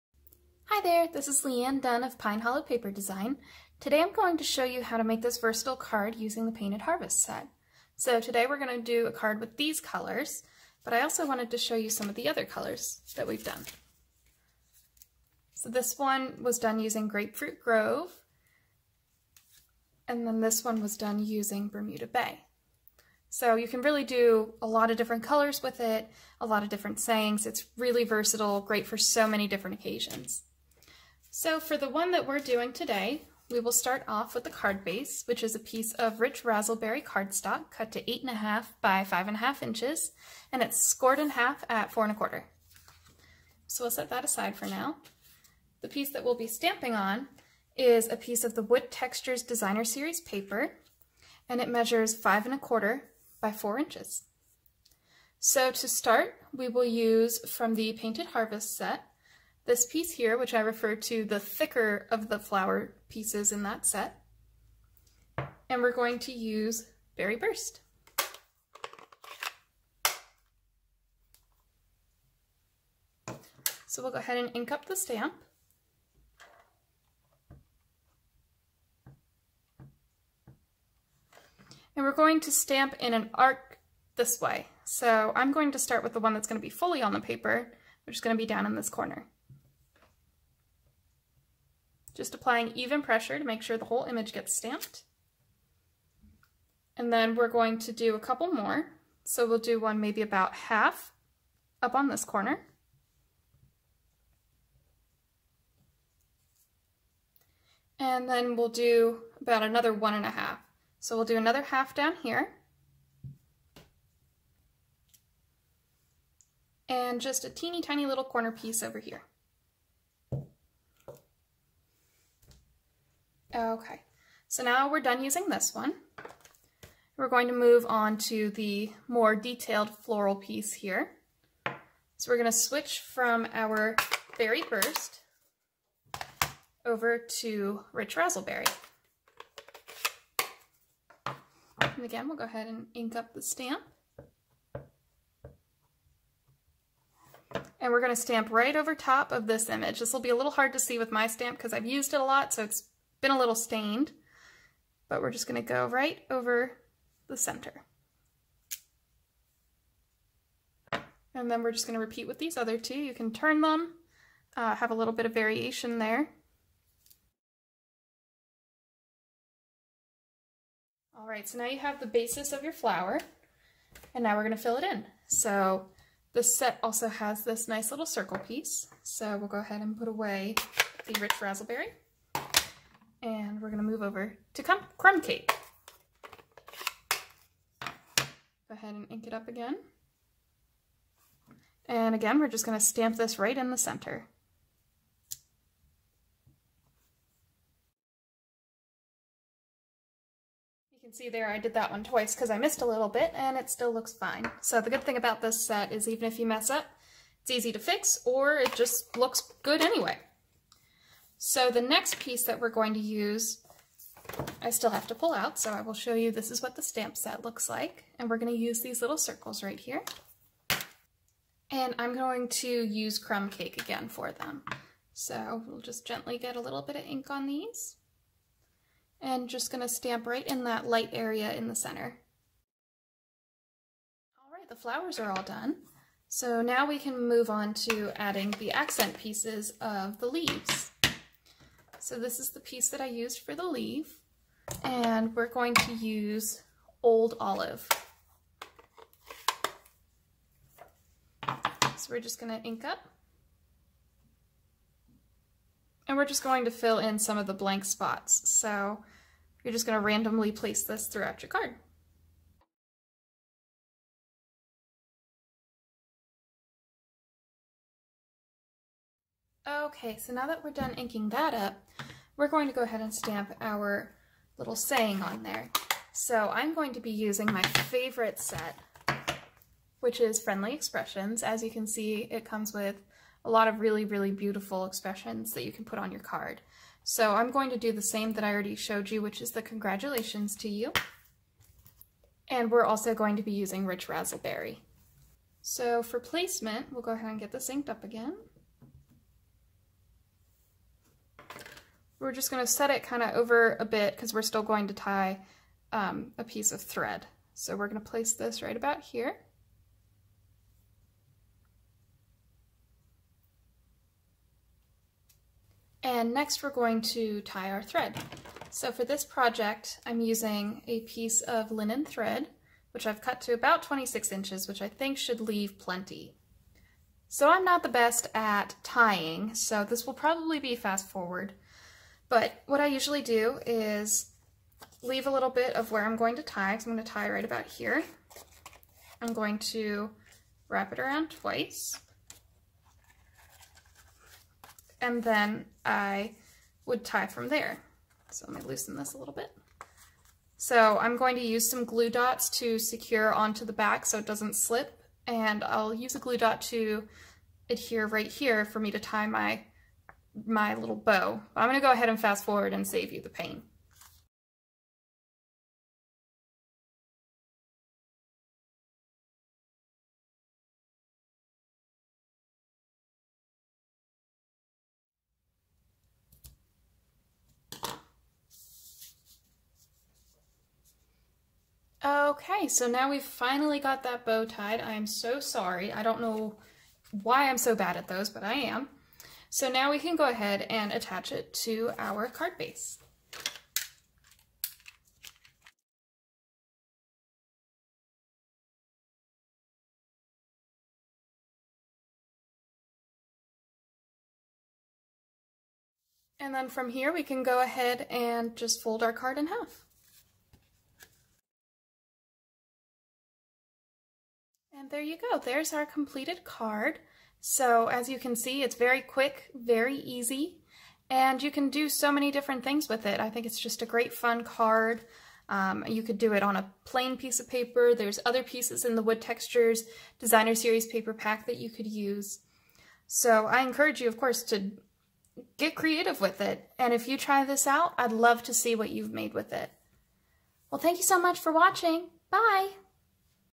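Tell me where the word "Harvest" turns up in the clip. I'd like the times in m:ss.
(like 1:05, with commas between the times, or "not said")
0:06, 0:58.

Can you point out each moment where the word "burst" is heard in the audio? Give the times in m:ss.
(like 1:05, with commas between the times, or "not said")
1:07, 2:14.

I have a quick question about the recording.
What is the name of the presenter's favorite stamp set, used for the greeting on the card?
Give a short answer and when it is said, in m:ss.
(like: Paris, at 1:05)
Friendly Expressions, at 4:40.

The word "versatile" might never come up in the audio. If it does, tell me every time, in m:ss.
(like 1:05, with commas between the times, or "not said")
0:05, 0:28.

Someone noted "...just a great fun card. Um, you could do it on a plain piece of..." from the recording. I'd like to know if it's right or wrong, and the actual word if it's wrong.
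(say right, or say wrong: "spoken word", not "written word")
right.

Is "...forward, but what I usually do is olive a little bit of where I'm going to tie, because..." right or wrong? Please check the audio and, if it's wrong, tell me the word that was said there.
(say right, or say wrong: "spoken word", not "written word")
wrong: "leave", not "olive".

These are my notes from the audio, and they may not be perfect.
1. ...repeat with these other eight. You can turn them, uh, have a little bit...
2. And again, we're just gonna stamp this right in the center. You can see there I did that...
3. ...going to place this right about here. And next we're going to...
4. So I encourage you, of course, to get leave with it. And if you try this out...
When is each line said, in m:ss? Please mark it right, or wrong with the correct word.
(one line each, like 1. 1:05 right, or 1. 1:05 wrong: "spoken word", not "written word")
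1. 2:41 wrong: "two", not "eight"
2. 3:11 right
3. 5:07 right
4. 7:13 wrong: "creative", not "leave".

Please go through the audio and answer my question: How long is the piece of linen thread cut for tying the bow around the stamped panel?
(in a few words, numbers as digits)
26 inches.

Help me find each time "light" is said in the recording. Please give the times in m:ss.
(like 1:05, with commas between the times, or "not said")
3:50.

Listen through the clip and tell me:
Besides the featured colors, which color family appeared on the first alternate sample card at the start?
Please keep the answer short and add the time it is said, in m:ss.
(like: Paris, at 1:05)
Grapefruit Grove, at 0:17.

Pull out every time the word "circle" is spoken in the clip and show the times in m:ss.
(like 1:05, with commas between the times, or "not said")
2:58, 3:39.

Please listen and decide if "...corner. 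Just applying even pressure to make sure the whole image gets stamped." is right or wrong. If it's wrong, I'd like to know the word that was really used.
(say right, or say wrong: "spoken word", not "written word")
right.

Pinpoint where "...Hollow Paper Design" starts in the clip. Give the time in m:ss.
0:02.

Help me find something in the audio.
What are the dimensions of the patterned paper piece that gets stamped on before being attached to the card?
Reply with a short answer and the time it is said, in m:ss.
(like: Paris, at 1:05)
5 1/4 by 4 inches, at 0:52.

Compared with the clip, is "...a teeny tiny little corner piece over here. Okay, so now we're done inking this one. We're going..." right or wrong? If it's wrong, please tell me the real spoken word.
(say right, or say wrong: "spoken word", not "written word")
wrong: "using", not "inking".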